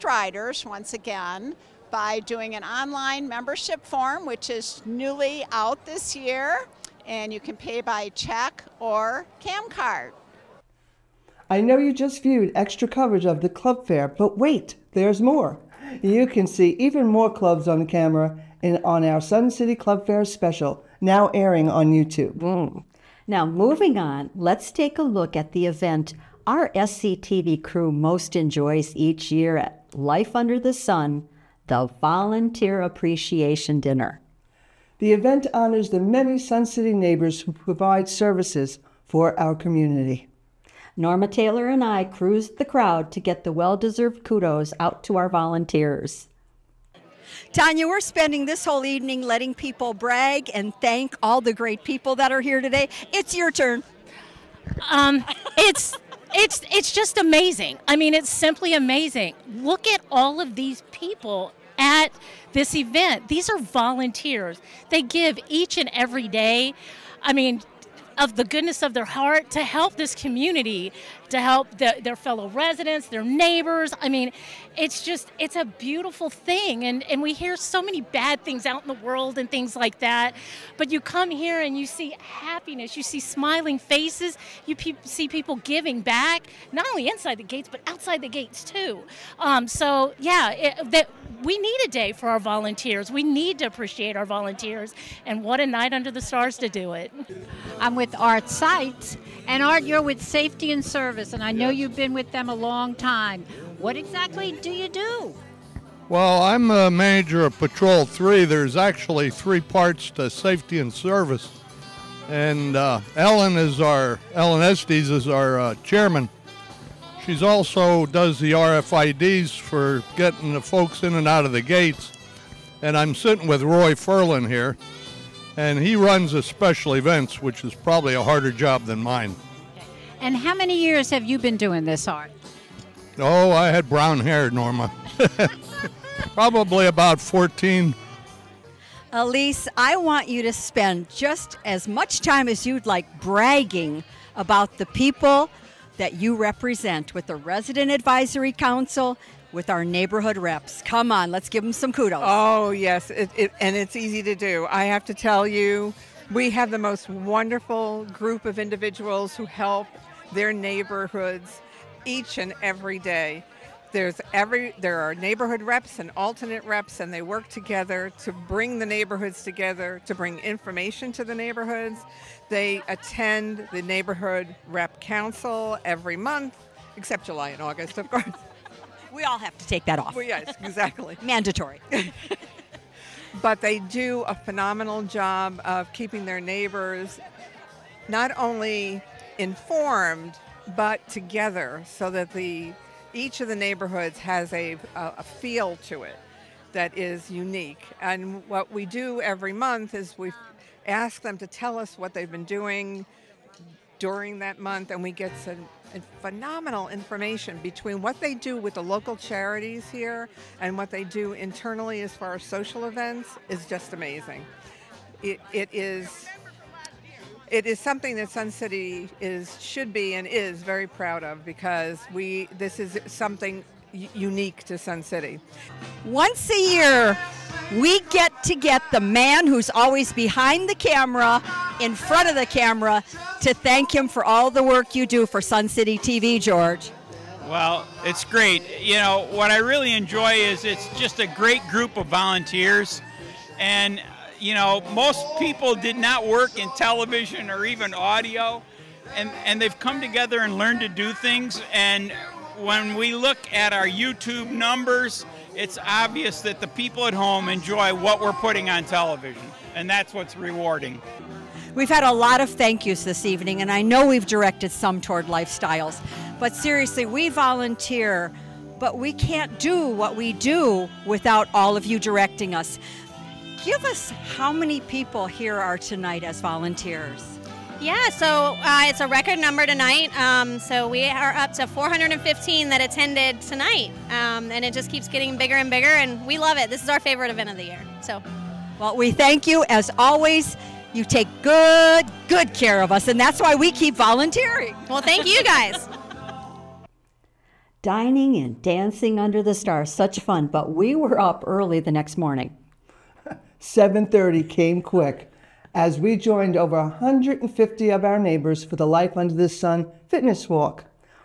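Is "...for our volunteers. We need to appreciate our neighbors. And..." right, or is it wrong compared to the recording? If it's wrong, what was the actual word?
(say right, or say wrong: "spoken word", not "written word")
wrong: "volunteers", not "neighbors".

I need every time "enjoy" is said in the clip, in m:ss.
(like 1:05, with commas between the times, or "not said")
0:28, 3:59, 4:17.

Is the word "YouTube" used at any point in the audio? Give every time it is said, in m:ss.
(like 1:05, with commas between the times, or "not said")
0:21, 4:13.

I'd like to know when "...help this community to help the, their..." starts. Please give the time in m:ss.
1:09.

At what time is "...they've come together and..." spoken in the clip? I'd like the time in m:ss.
4:09.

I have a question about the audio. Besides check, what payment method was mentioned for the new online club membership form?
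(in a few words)
CamCard.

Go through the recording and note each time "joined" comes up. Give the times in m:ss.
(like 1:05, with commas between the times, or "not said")
5:06.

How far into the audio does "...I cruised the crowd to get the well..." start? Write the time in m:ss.
0:41.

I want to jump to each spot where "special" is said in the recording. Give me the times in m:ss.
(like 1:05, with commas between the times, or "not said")
0:20, 2:06.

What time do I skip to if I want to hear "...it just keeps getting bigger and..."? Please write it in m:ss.
4:44.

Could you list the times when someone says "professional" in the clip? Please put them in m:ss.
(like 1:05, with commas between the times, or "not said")
not said.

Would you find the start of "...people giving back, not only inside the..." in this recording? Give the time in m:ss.
1:25.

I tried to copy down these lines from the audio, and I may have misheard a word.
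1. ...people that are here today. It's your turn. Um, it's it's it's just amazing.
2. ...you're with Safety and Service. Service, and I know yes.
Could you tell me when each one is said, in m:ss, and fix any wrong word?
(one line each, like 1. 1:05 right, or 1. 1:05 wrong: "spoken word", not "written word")
1. 0:51 right
2. 1:39 right.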